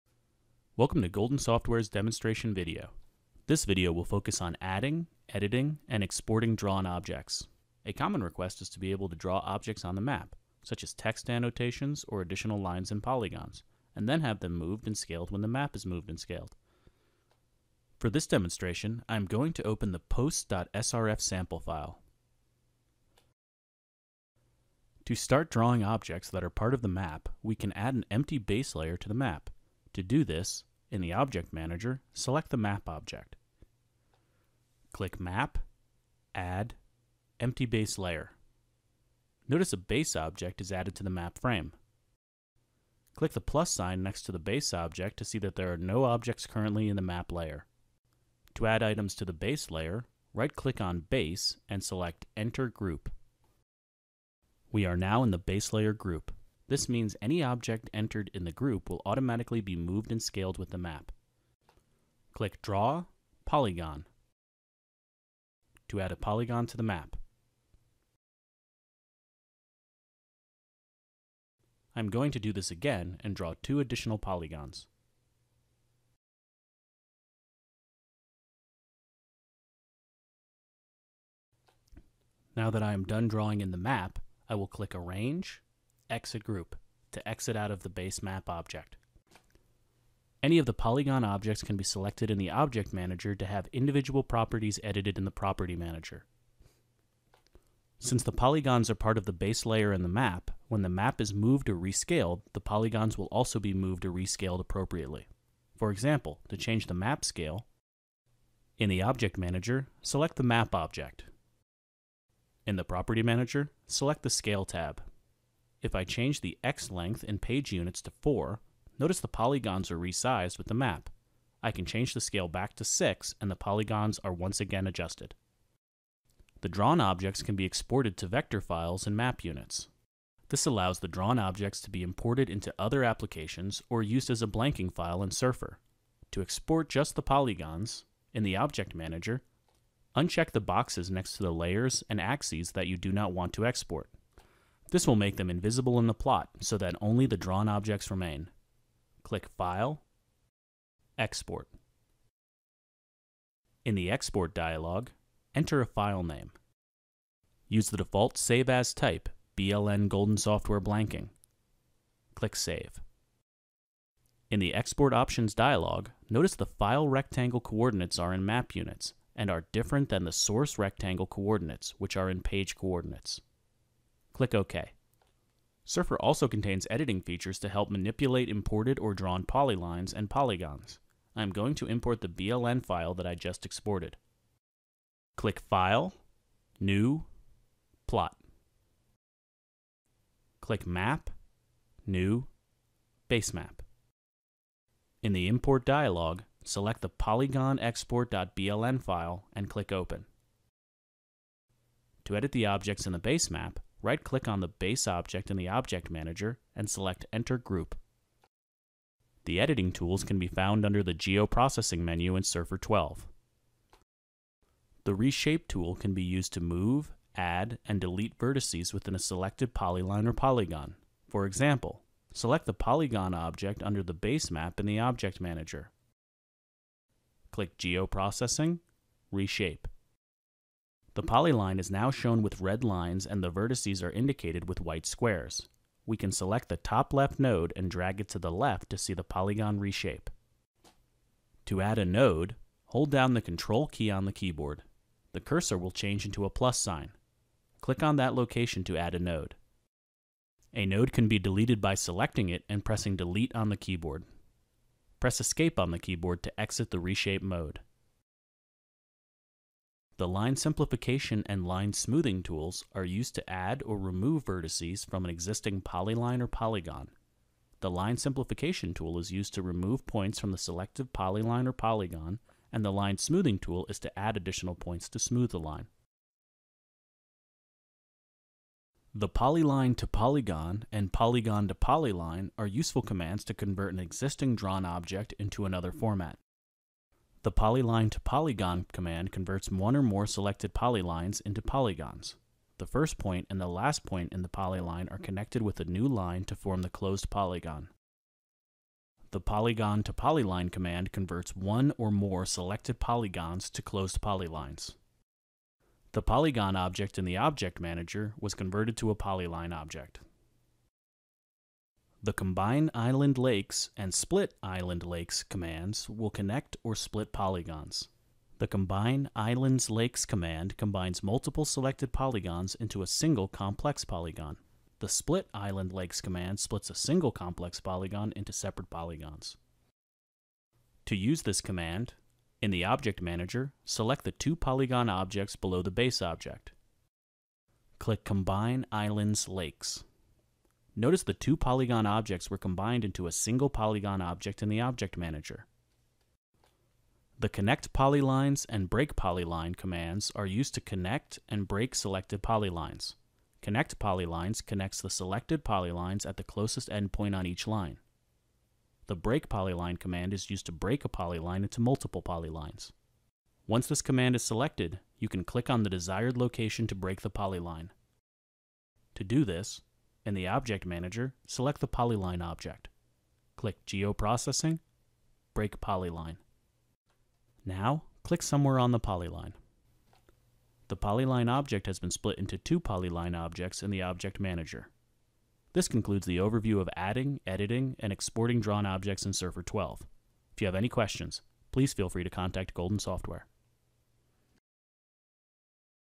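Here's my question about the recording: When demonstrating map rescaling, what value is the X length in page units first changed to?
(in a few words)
4.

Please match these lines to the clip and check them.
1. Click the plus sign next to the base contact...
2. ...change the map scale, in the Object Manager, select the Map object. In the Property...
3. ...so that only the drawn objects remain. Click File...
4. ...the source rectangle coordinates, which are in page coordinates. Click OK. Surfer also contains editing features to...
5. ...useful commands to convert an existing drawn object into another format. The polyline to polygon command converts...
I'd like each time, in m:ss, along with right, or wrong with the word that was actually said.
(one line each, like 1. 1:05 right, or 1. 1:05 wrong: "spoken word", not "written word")
1. 0:43 wrong: "object", not "contact"
2. 1:46 right
3. 2:26 right
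4. 2:50 right
5. 4:42 right.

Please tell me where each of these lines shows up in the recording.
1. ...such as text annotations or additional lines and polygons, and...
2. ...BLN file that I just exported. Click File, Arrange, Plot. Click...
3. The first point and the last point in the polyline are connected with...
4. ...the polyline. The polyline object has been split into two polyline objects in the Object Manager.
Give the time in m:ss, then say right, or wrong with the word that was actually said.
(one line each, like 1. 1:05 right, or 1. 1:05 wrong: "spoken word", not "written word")
1. 0:10 right
2. 3:02 wrong: "New", not "Arrange"
3. 4:52 right
4. 6:18 right.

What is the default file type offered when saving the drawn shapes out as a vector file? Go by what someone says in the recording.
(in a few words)
BLN Golden Software Blanking.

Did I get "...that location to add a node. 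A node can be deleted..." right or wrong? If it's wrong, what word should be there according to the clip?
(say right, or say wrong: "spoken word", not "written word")
right.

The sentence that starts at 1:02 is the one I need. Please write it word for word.
Click Draw, Polygon to add a polygon to the map.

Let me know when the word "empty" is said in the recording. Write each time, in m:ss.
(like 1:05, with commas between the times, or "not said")
0:28, 0:37.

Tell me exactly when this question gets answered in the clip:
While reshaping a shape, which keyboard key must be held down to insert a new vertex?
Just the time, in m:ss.
4:03.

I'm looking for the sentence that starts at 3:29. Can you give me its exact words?
The editing tools can be found under the Geoprocessing menu in Surfer 12.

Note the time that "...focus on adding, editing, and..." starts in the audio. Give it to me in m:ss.
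0:04.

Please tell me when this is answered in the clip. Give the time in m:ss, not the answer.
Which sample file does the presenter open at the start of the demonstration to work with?
0:19.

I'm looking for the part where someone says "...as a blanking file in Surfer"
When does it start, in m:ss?
2:14.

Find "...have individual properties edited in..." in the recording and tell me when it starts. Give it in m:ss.
1:33.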